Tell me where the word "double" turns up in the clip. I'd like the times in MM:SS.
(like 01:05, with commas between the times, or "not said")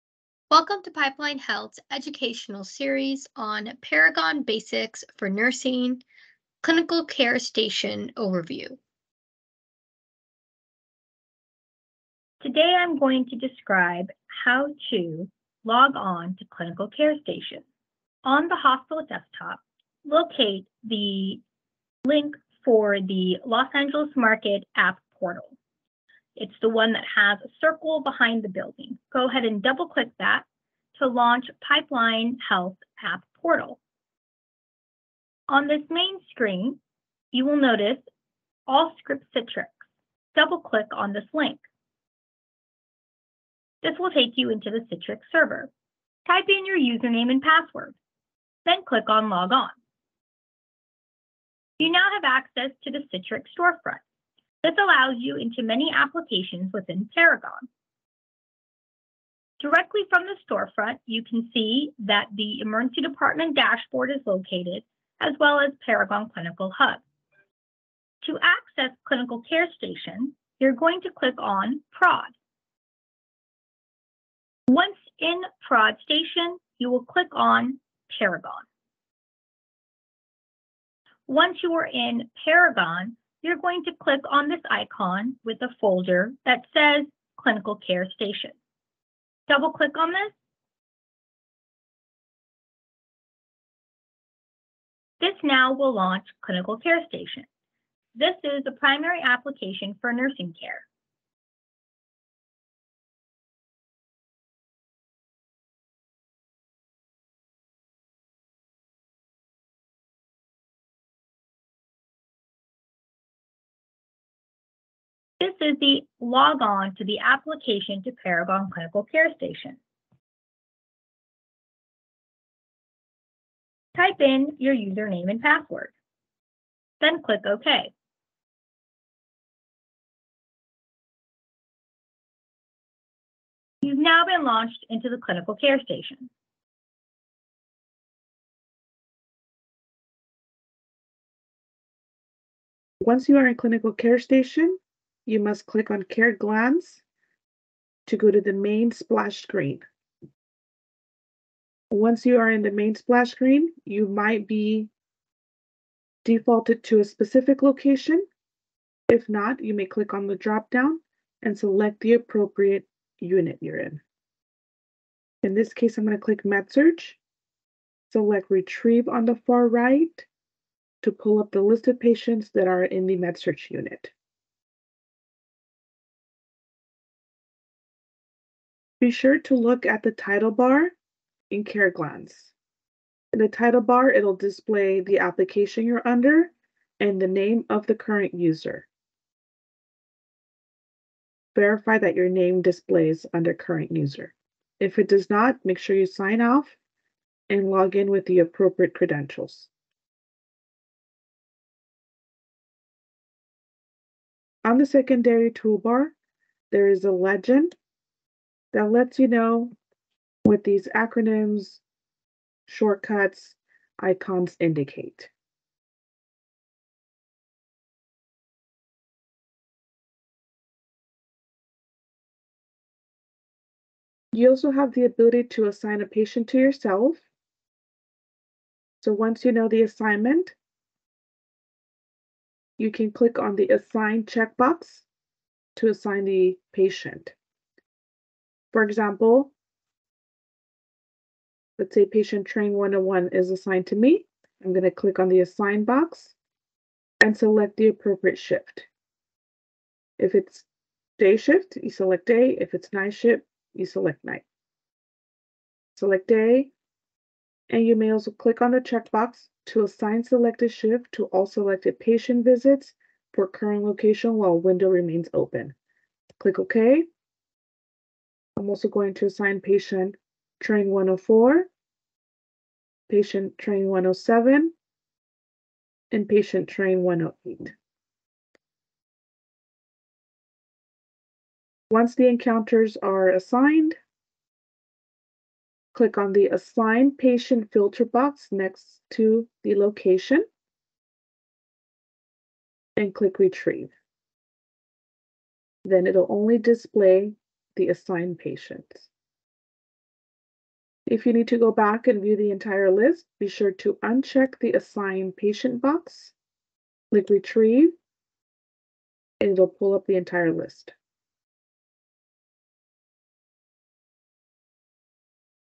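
00:29, 00:40, 01:29.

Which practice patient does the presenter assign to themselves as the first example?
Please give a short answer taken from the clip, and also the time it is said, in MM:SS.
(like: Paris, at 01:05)
patient train 101, at 04:02.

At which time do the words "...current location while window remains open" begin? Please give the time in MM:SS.
04:23.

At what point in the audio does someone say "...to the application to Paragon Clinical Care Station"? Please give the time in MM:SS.
01:56.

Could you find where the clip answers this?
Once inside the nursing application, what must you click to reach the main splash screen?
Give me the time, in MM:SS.
02:26.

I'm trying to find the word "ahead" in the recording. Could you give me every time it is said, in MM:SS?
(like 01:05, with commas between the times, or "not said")
00:29.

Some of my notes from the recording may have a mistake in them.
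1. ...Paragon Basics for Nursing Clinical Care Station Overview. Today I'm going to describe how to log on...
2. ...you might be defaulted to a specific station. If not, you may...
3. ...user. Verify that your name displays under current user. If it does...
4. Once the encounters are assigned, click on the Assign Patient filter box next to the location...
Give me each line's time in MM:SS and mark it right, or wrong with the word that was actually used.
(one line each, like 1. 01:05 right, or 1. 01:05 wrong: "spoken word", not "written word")
1. 00:03 right
2. 02:33 wrong: "location", not "station"
3. 03:08 right
4. 04:41 right.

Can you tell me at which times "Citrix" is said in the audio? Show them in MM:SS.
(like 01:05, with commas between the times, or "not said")
00:39, 00:44, 00:53.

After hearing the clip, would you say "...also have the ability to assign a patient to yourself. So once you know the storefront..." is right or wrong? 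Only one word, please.
wrong.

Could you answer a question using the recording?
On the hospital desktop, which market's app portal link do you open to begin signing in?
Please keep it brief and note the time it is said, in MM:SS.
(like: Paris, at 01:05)
Los Angeles, at 00:23.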